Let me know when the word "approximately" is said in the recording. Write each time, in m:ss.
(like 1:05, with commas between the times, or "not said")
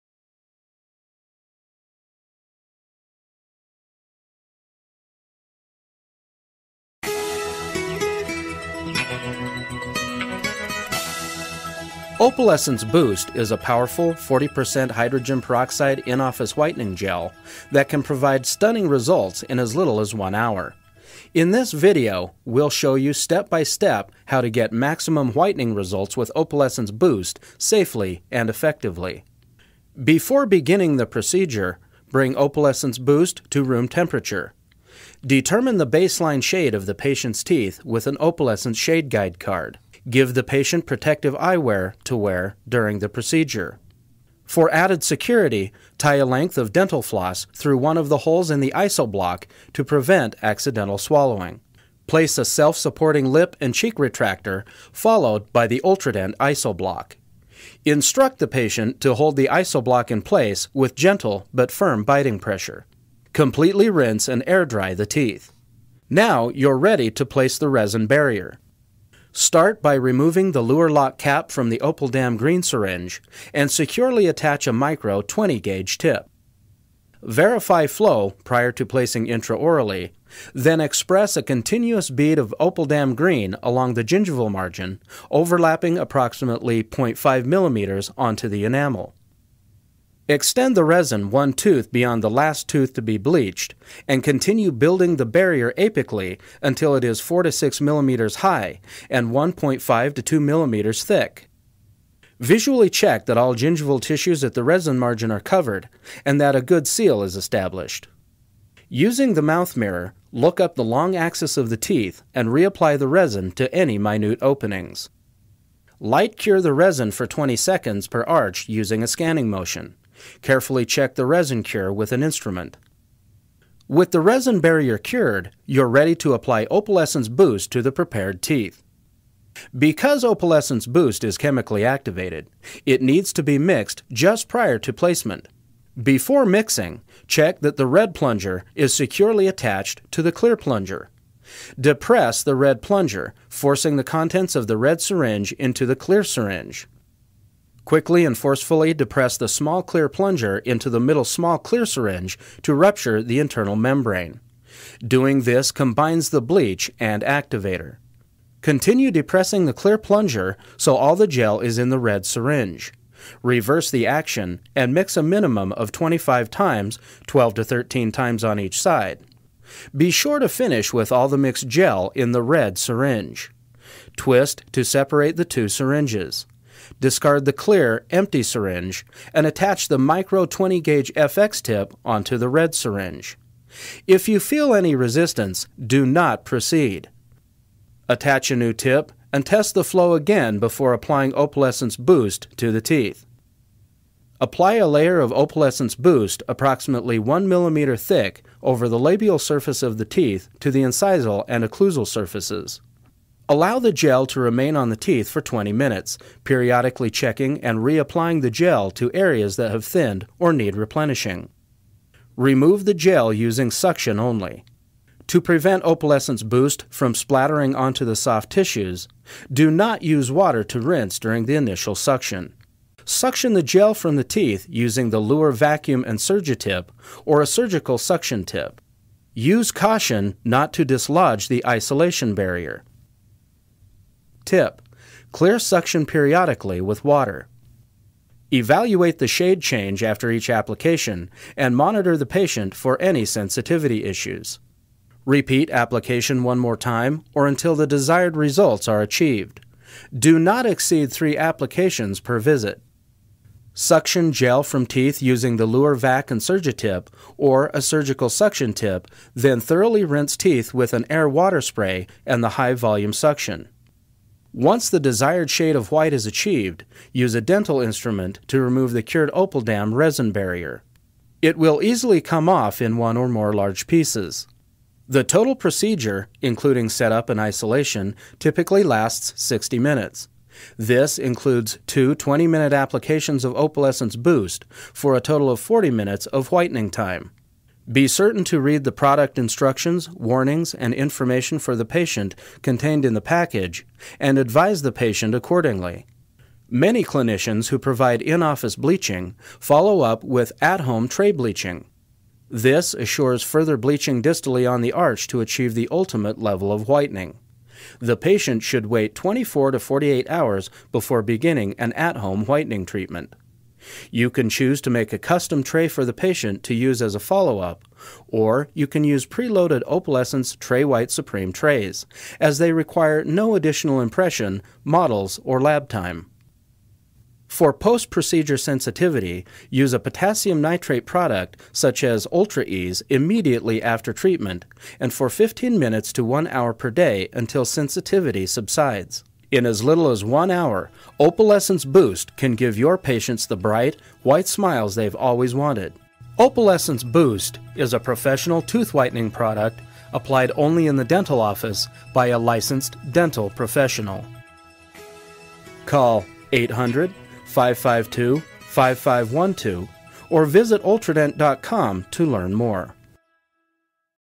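1:25, 3:16.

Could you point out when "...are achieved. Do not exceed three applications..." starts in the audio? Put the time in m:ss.
4:08.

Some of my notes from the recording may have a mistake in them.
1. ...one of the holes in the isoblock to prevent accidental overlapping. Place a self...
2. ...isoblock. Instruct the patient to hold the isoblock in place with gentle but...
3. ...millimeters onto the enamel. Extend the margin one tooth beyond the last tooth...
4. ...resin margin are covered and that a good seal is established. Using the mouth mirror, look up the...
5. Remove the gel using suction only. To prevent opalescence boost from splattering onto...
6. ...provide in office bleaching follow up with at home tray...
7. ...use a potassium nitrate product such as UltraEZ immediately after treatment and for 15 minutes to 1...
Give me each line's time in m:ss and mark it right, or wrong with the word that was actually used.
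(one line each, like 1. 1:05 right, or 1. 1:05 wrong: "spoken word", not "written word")
1. 0:47 wrong: "swallowing", not "overlapping"
2. 0:56 right
3. 1:27 wrong: "resin", not "margin"
4. 1:44 right
5. 3:32 right
6. 4:57 right
7. 5:29 right.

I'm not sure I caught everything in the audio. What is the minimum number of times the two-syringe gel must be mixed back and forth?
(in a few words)
25.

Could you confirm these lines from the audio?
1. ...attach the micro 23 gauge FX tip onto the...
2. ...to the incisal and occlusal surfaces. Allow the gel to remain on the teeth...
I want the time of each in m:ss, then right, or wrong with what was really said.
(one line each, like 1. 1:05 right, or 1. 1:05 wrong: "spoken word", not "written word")
1. 2:59 wrong: "20", not "23"
2. 3:20 right.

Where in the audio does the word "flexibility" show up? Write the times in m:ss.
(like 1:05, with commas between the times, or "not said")
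not said.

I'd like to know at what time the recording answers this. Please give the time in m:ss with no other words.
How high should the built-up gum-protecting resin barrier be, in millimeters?
1:37.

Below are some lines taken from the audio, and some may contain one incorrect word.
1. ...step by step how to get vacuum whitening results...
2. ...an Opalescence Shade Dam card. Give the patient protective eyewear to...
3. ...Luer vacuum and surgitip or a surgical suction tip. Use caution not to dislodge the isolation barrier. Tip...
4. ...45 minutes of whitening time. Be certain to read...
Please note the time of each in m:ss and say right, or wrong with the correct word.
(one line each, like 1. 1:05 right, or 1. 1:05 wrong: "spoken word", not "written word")
1. 0:23 wrong: "maximum", not "vacuum"
2. 0:38 wrong: "Guide", not "Dam"
3. 3:45 right
4. 4:45 wrong: "40", not "45".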